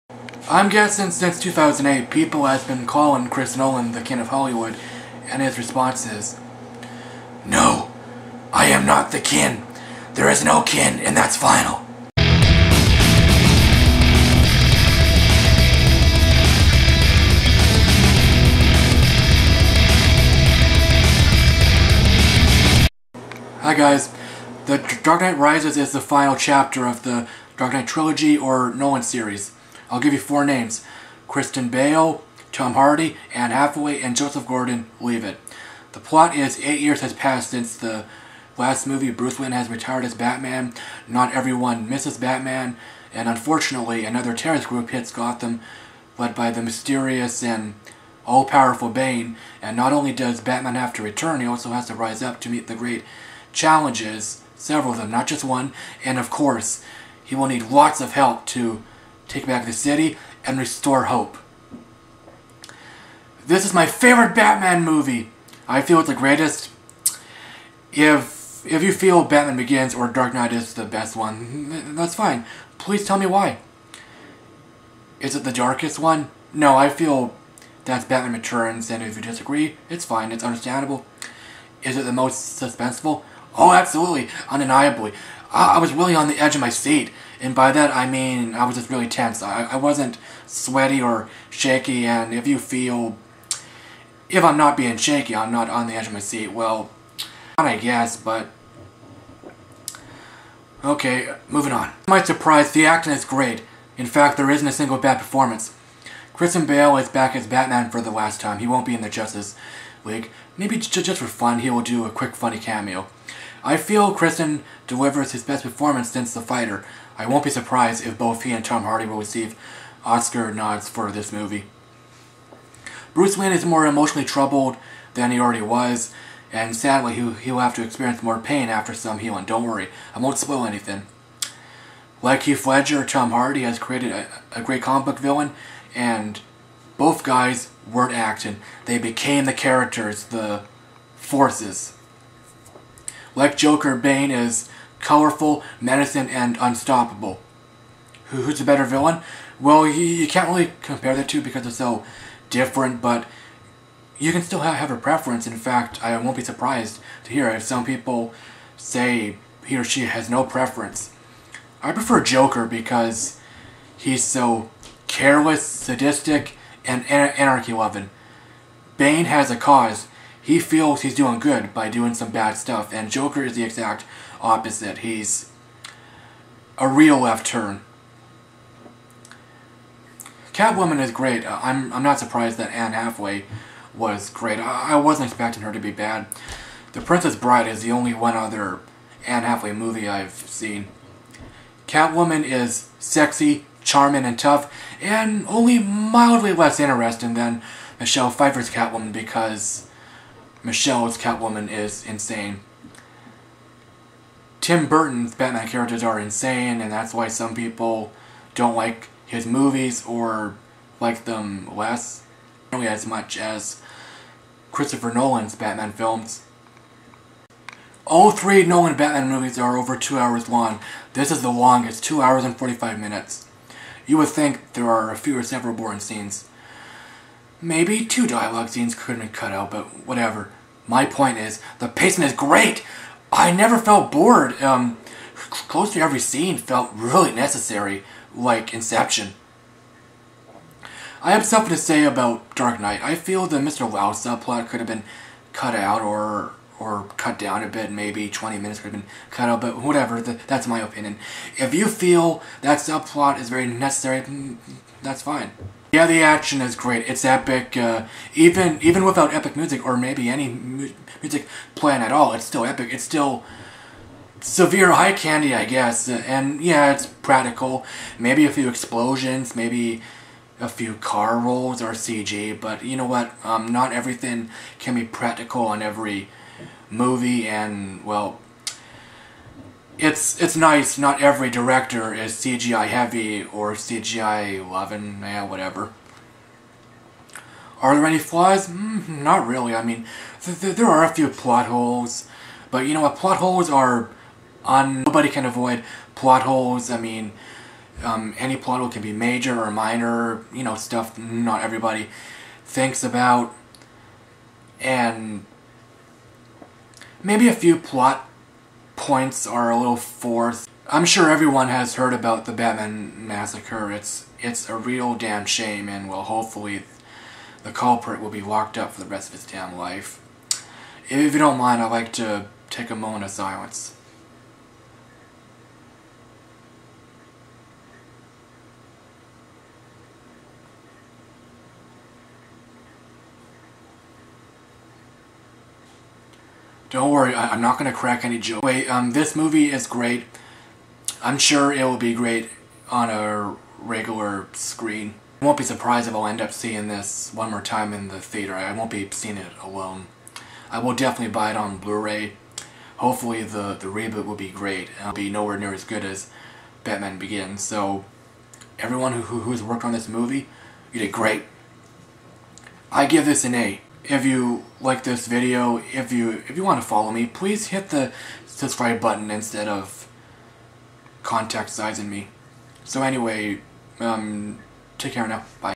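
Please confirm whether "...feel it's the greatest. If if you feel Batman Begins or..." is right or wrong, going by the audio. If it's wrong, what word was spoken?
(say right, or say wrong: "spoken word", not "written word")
right.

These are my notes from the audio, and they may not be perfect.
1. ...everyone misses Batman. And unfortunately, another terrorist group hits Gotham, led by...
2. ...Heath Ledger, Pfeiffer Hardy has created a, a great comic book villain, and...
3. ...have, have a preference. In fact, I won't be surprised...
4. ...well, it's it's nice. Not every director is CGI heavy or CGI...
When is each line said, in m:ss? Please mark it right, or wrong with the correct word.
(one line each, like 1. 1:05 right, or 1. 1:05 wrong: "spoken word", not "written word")
1. 0:41 right
2. 2:12 wrong: "Tom", not "Pfeiffer"
3. 2:34 right
4. 4:38 right.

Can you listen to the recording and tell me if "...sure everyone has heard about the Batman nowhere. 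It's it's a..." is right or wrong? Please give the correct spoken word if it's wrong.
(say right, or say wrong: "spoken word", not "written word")
wrong: "massacre", not "nowhere".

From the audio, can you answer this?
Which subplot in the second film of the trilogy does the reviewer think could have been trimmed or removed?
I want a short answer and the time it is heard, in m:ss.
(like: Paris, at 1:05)
Mr. Lau subplot, at 4:03.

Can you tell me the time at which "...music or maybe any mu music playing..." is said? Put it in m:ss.
4:19.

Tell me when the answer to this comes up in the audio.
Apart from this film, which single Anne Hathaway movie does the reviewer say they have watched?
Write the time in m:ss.
3:06.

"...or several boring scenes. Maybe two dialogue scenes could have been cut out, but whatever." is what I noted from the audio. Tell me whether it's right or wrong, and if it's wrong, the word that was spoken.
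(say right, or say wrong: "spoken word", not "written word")
right.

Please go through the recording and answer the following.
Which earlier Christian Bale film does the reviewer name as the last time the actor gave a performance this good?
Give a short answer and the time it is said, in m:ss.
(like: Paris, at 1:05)
The Fighter, at 1:56.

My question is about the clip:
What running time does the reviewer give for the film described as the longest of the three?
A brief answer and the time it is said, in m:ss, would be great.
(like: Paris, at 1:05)
2 hours 45 minutes, at 3:42.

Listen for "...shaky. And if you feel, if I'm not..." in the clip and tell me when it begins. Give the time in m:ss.
1:31.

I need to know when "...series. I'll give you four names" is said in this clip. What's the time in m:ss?
0:29.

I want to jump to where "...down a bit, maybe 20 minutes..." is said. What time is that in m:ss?
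4:07.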